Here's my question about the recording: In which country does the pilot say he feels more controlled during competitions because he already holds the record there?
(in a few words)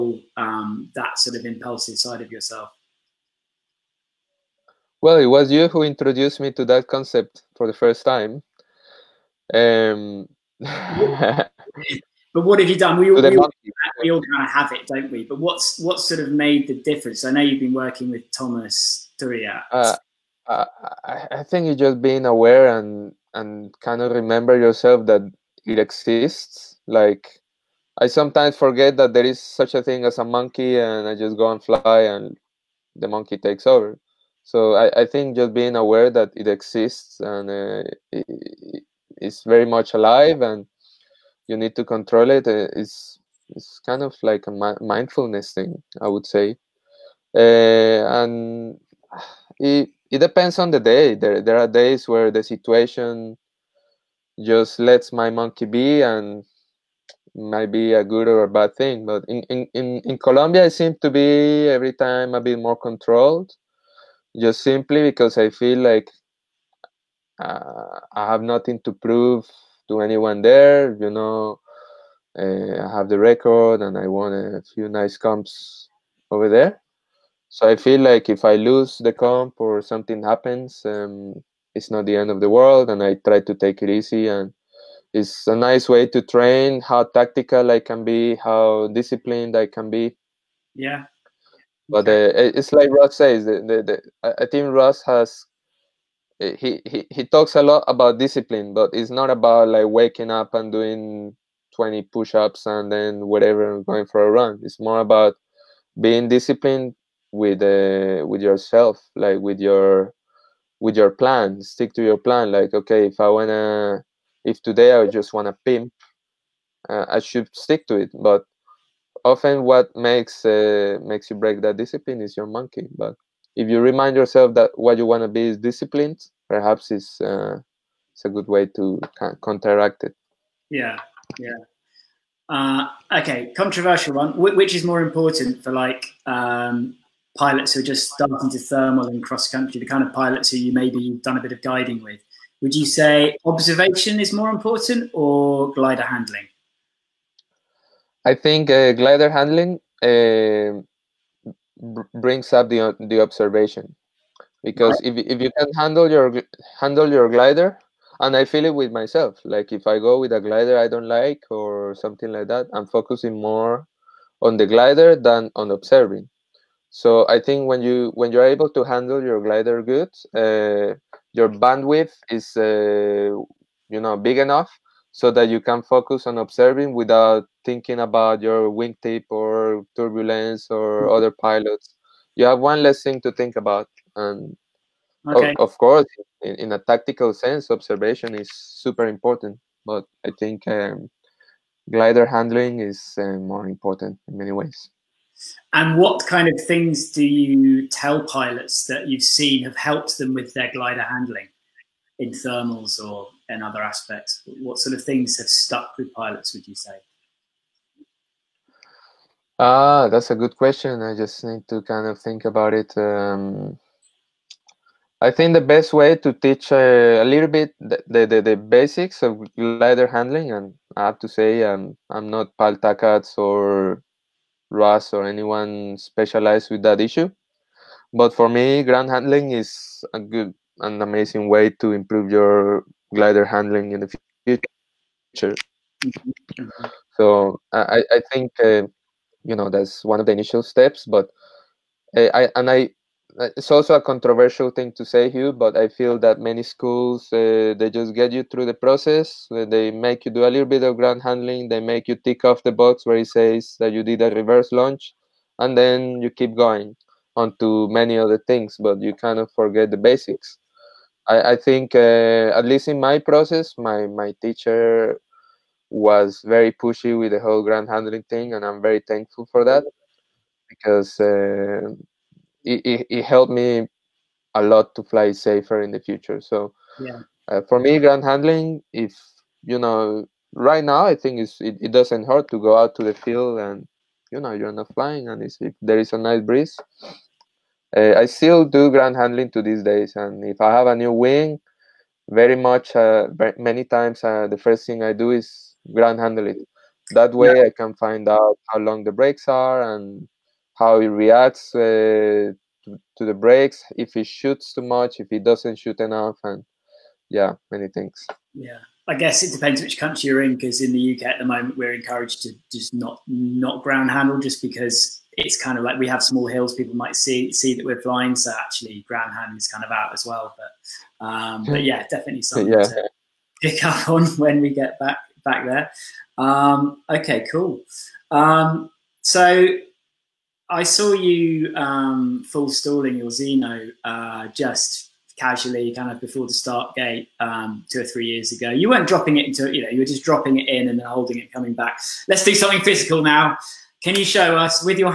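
Colombia.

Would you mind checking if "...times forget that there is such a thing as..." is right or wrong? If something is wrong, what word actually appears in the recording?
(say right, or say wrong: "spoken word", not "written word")
wrong: "sometimes", not "times".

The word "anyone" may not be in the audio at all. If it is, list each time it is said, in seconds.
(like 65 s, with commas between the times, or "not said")
69 s, 225 s.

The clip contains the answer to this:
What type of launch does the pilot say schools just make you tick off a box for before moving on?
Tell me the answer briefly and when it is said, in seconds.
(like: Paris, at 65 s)
reverse launch, at 254 s.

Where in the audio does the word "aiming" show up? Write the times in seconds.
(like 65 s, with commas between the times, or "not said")
not said.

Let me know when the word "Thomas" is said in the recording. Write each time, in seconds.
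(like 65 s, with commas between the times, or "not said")
18 s.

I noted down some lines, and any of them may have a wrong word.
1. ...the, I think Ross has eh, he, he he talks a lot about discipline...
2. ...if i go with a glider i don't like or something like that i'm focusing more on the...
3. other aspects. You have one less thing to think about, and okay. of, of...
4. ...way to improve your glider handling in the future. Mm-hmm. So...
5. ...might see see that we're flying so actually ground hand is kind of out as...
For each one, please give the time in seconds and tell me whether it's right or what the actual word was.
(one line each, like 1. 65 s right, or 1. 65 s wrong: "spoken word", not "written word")
1. 94 s right
2. 159 s right
3. 181 s wrong: "pilots", not "aspects"
4. 231 s right
5. 316 s right.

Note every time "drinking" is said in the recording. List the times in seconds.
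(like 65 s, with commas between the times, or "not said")
not said.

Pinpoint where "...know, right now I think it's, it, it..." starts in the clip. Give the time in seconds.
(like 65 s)
279 s.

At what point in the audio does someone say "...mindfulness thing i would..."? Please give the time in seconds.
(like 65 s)
44 s.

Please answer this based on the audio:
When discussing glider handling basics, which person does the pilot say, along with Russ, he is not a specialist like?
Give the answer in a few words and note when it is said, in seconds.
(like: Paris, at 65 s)
Pal Takats, at 222 s.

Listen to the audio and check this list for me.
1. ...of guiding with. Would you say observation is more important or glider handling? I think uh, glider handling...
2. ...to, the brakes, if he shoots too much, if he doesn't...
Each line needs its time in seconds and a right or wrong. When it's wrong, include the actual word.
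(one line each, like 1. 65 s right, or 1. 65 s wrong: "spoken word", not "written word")
1. 141 s right
2. 301 s right.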